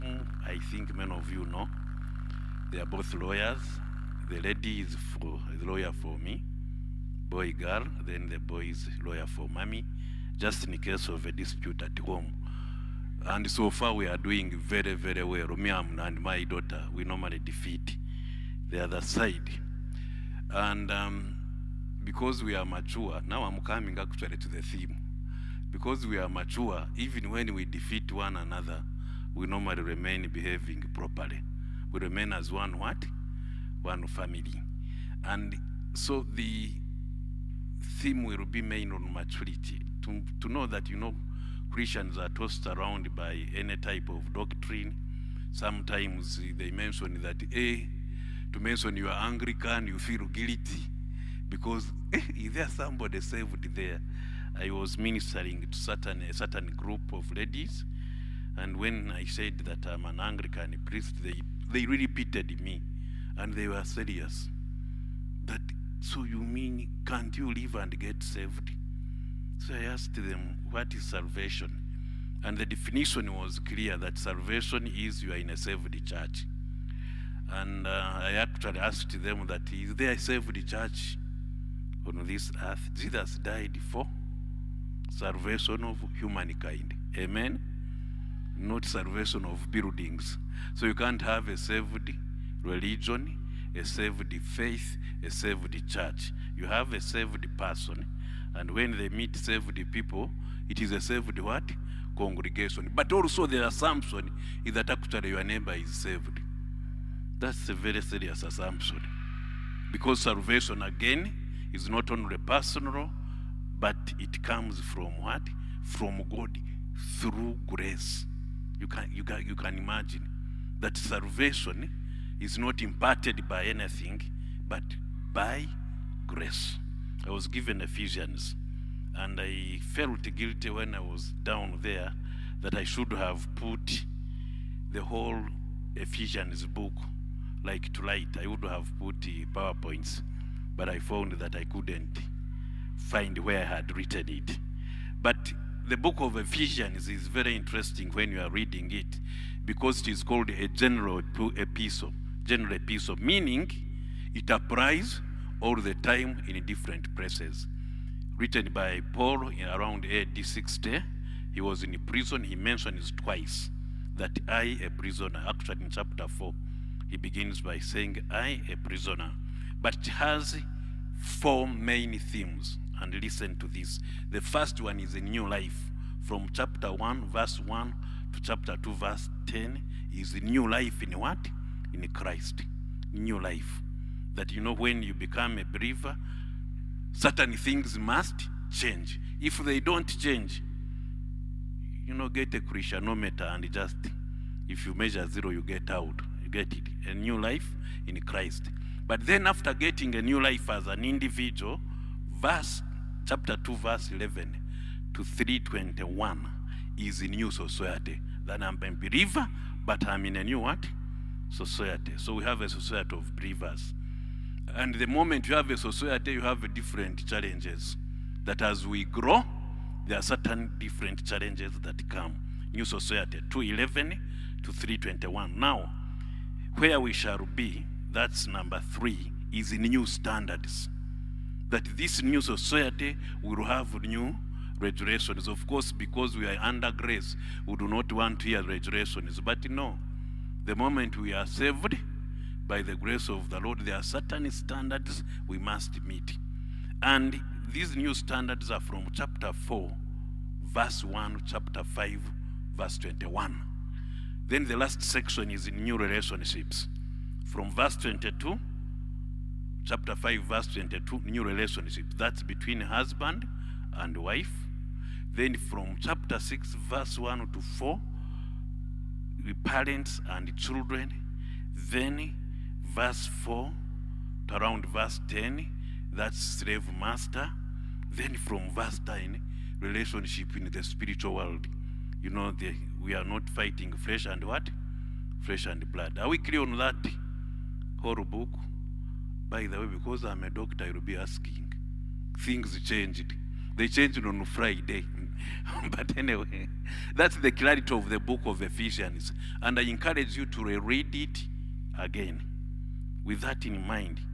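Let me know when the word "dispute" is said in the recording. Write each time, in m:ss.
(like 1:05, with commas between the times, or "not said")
0:11.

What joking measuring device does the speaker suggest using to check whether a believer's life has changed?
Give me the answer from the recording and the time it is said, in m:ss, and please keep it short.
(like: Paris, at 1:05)
Christianometer, at 3:12.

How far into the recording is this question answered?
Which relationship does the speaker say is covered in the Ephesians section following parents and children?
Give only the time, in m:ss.
4:36.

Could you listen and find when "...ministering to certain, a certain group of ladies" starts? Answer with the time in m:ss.
0:54.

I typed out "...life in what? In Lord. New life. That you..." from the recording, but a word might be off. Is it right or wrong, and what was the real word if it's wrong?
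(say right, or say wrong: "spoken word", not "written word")
wrong: "Christ", not "Lord".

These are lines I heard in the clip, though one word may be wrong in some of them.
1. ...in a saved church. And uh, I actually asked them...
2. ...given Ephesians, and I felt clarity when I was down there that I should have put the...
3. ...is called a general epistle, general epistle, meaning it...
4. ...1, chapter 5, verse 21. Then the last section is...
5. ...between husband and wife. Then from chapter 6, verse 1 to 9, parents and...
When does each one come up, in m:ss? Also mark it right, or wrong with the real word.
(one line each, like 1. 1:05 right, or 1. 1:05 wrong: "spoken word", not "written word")
1. 1:15 right
2. 2:07 wrong: "guilty", not "clarity"
3. 2:30 right
4. 4:11 right
5. 4:22 wrong: "4", not "9".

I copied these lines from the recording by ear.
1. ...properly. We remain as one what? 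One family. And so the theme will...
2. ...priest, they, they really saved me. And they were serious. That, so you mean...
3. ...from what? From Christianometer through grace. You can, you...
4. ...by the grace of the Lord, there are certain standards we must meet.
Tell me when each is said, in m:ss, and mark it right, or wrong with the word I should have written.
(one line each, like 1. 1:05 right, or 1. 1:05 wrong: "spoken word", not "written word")
1. 0:30 right
2. 1:00 wrong: "pitied", not "saved"
3. 1:54 wrong: "God", not "Christianometer"
4. 4:02 right.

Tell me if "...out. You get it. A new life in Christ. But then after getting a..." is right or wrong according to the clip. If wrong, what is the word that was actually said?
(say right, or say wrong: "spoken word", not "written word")
right.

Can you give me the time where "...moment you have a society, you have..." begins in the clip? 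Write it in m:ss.
3:35.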